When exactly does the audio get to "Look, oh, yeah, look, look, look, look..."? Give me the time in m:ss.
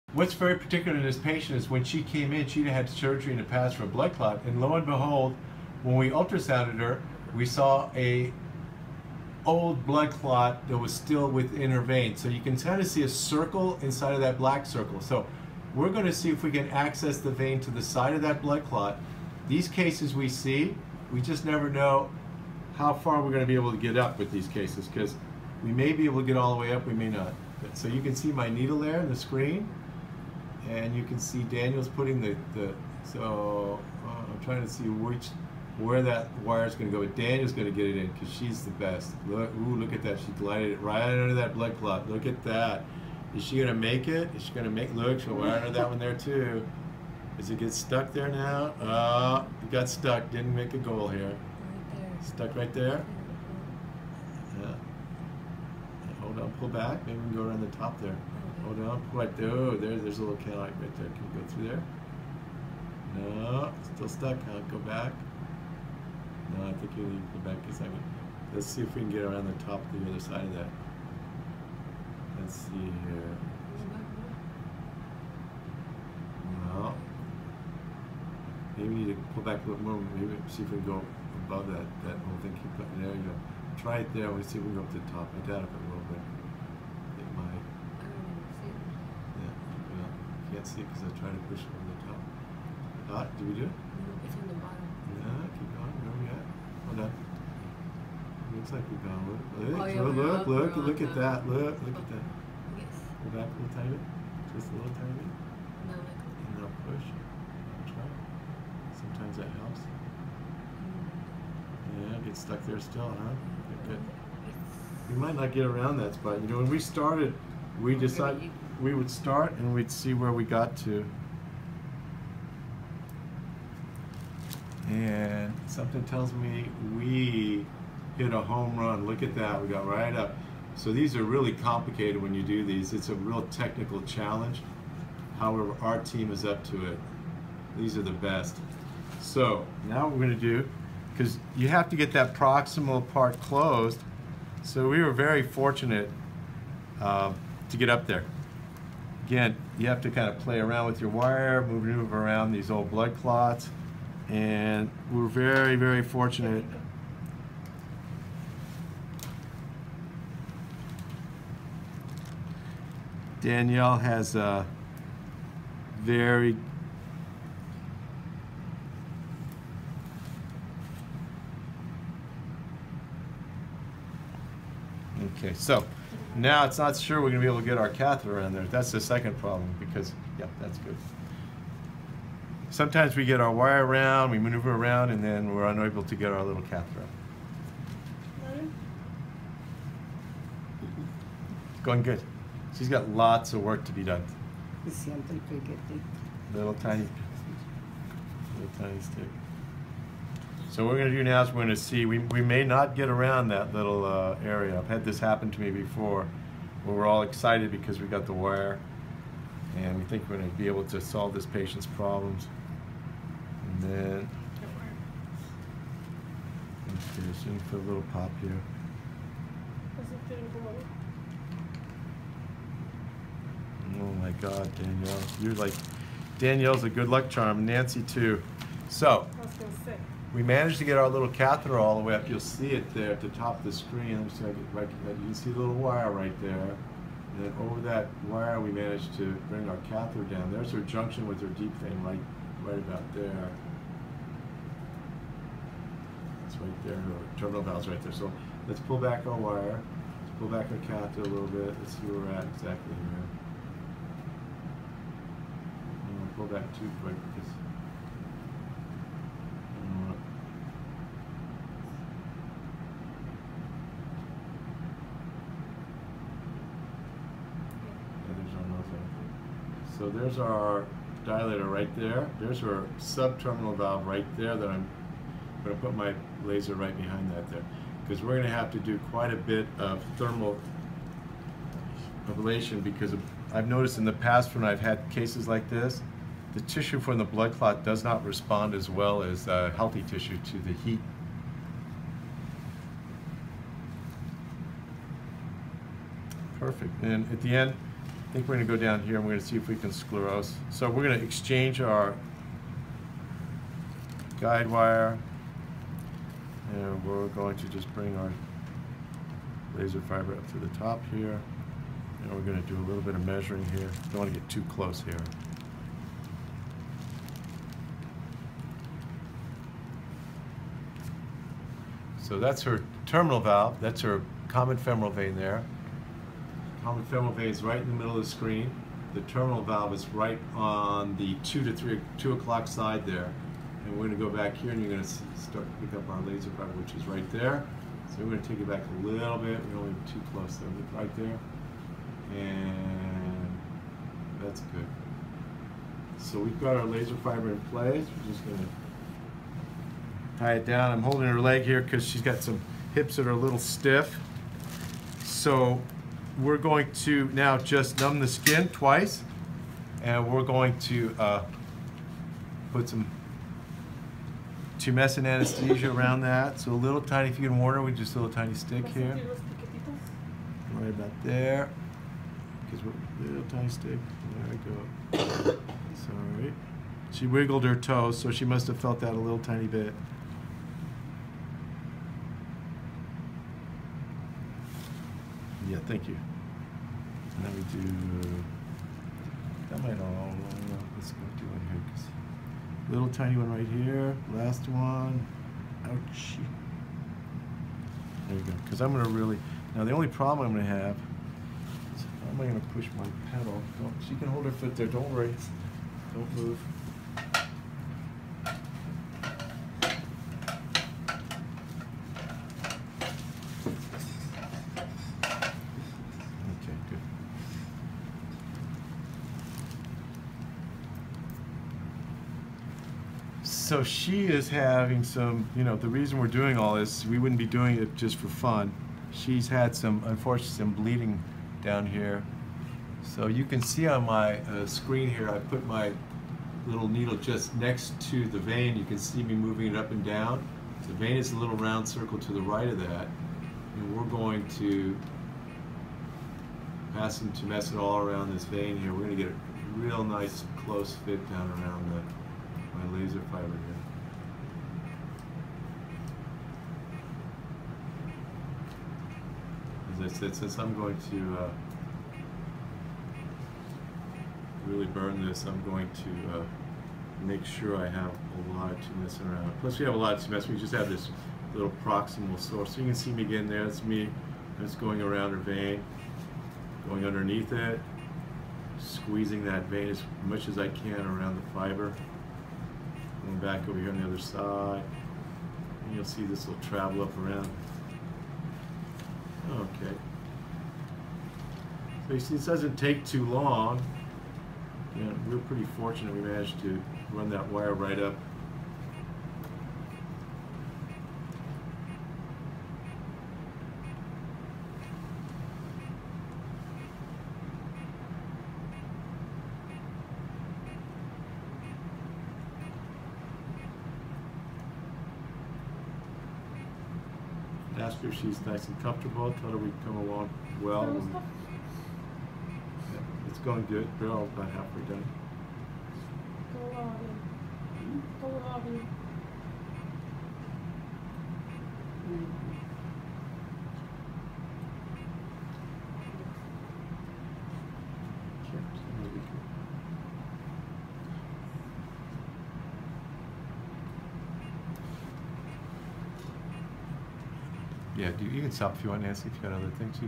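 1:39.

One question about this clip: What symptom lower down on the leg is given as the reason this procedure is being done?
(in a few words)
bleeding.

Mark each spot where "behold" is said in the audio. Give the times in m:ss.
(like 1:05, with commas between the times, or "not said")
0:04.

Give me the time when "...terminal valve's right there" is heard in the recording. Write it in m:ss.
4:07.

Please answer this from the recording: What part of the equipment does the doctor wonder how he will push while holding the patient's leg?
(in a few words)
pedal.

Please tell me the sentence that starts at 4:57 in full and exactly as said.
And at the end, I think we're going to go down here and we're going to see if we can sclerose.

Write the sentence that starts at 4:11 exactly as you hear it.
Let's see where we're at exactly here.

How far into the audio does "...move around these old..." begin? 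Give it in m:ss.
2:31.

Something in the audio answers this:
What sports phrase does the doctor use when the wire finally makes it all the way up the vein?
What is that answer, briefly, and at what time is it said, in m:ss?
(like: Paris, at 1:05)
home run, at 2:08.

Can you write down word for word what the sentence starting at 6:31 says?
Cause little tiny one right here, last one, ouch.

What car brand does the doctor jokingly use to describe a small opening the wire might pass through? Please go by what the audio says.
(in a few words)
Cadillac.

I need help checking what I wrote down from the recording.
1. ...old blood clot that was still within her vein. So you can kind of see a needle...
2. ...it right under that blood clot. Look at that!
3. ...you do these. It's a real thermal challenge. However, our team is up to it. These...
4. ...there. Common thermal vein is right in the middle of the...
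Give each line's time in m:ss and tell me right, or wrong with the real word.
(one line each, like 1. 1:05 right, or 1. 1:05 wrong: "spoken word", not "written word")
1. 0:09 wrong: "circle", not "needle"
2. 0:40 right
3. 2:12 wrong: "technical", not "thermal"
4. 5:25 wrong: "femoral", not "thermal".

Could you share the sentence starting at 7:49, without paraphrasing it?
Plus we have a lot to mess, we just have this little proximal source.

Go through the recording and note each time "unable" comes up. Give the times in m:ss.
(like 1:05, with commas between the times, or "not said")
3:05.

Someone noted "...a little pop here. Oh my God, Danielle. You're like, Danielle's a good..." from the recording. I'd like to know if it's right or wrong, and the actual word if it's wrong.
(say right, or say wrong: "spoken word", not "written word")
right.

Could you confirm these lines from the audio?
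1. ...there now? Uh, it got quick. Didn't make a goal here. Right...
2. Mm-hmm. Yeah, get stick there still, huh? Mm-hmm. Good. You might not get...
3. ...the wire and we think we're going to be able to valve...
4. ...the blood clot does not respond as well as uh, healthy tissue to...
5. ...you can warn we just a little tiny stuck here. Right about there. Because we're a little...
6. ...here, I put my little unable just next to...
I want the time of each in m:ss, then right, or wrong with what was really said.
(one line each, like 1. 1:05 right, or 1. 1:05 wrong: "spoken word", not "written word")
1. 0:48 wrong: "stuck", not "quick"
2. 1:51 wrong: "stuck", not "stick"
3. 3:28 wrong: "solve", not "valve"
4. 4:47 right
5. 6:07 wrong: "stick", not "stuck"
6. 7:15 wrong: "needle", not "unable".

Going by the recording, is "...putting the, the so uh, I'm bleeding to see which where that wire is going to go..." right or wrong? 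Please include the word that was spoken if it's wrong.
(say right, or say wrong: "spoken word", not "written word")
wrong: "trying", not "bleeding".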